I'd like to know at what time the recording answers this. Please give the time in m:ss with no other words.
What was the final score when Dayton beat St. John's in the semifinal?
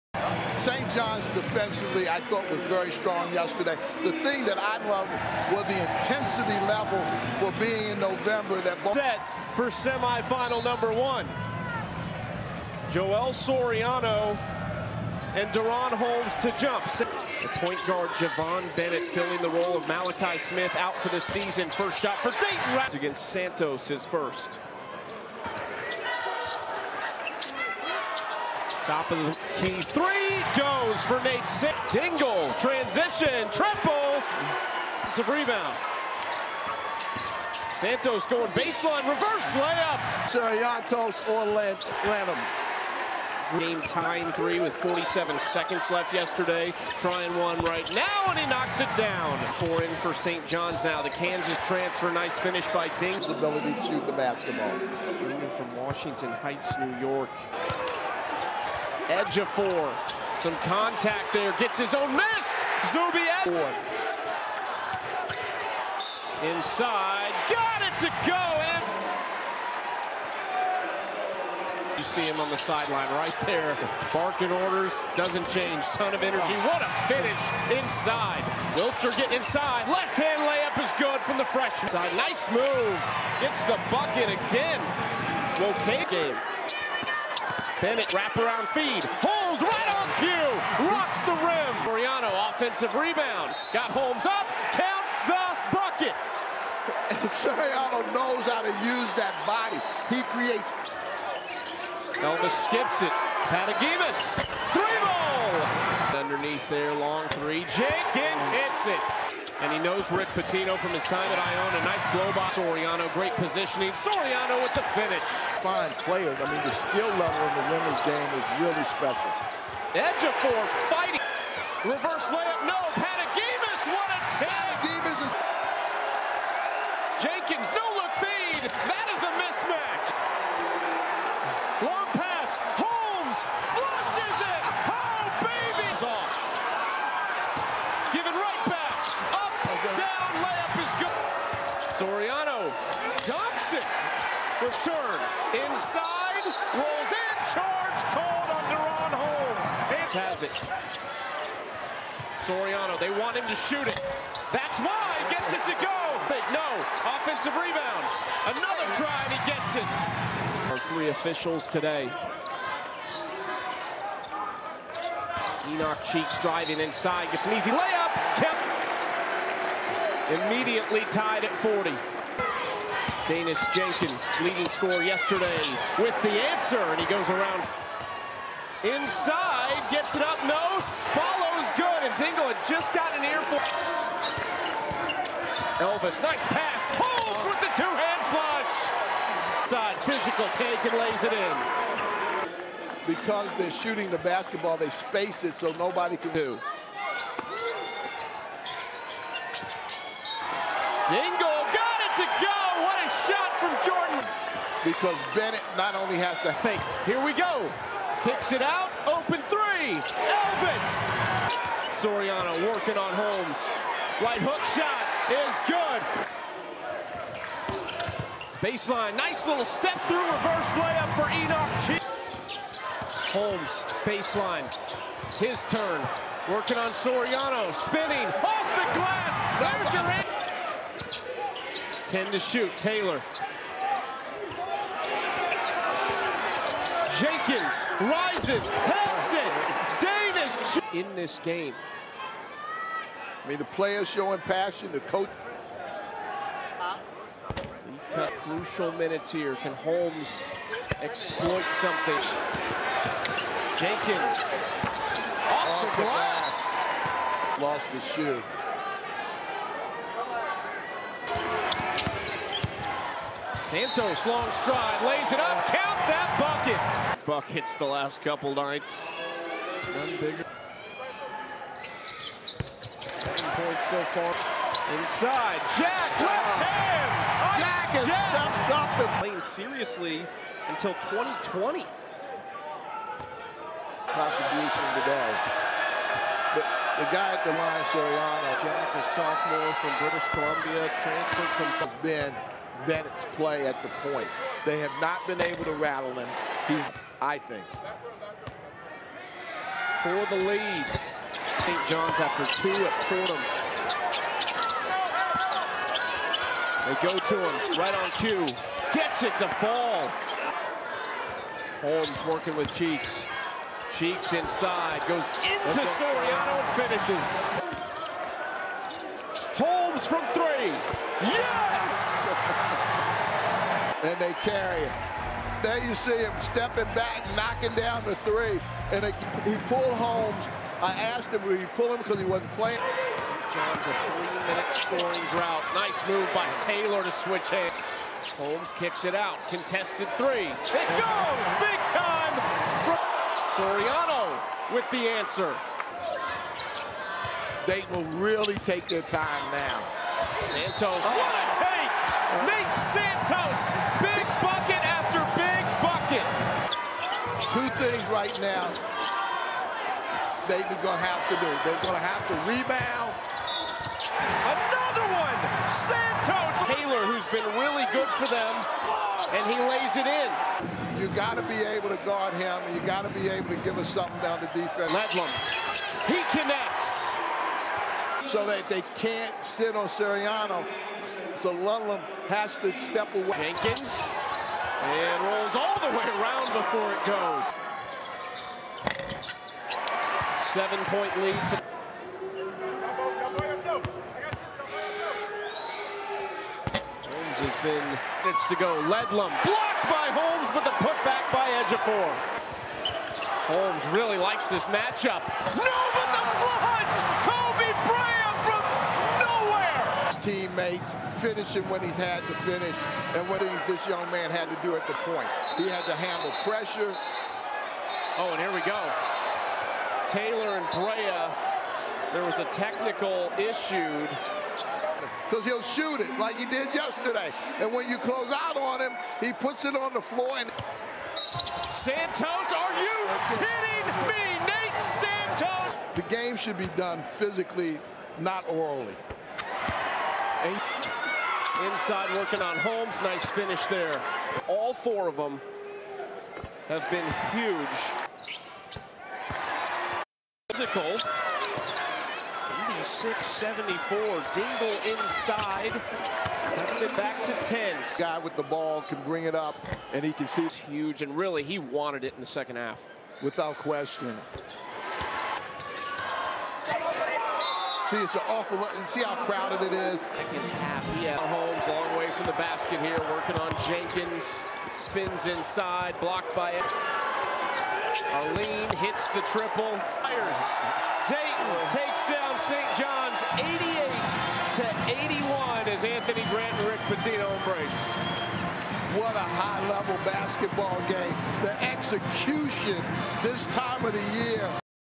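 8:03.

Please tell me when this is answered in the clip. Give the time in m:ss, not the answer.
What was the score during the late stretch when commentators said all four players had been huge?
7:32.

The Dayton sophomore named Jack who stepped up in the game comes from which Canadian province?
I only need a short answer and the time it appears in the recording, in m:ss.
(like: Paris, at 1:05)
British Columbia, at 4:50.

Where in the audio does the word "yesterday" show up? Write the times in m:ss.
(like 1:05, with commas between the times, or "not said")
0:03, 0:46, 2:55, 7:06.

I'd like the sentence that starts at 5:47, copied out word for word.
They will really take their time now.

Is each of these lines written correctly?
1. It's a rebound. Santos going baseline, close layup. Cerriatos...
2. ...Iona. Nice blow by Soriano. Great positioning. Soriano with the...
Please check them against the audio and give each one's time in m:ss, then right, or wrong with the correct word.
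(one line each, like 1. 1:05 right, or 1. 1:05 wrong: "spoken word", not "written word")
1. 0:35 wrong: "reverse", not "close"
2. 1:51 right.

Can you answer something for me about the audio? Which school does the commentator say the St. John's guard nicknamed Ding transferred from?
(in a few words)
Kansas.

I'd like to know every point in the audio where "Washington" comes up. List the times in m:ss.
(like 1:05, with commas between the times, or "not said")
0:55.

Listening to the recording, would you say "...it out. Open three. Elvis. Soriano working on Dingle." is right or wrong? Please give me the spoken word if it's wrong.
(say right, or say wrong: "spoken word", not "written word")
wrong: "Holmes", not "Dingle".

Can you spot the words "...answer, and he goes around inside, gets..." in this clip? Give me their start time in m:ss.
2:56.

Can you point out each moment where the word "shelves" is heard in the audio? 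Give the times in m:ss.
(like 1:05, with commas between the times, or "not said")
not said.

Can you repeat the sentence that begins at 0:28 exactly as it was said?
Top of the Key three goes for Nate Sick.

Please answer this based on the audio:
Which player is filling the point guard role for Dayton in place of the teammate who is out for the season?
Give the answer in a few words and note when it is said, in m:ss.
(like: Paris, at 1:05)
Javon Bennett, at 0:18.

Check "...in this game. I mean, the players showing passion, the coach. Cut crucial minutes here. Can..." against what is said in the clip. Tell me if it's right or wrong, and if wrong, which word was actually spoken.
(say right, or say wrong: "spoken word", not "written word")
right.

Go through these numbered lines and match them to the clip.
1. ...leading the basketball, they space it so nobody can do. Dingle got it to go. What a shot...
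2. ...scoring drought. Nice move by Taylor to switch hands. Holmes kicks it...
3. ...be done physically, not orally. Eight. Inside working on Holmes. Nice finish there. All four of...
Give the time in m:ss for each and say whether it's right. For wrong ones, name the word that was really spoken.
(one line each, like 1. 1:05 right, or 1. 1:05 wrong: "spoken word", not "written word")
1. 3:13 wrong: "shooting", not "leading"
2. 5:34 right
3. 7:16 right.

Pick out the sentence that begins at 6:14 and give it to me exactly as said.
Ledlum, he connects so that they can't sit on Soriano.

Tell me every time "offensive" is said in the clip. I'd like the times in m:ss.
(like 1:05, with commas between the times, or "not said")
1:32, 2:37.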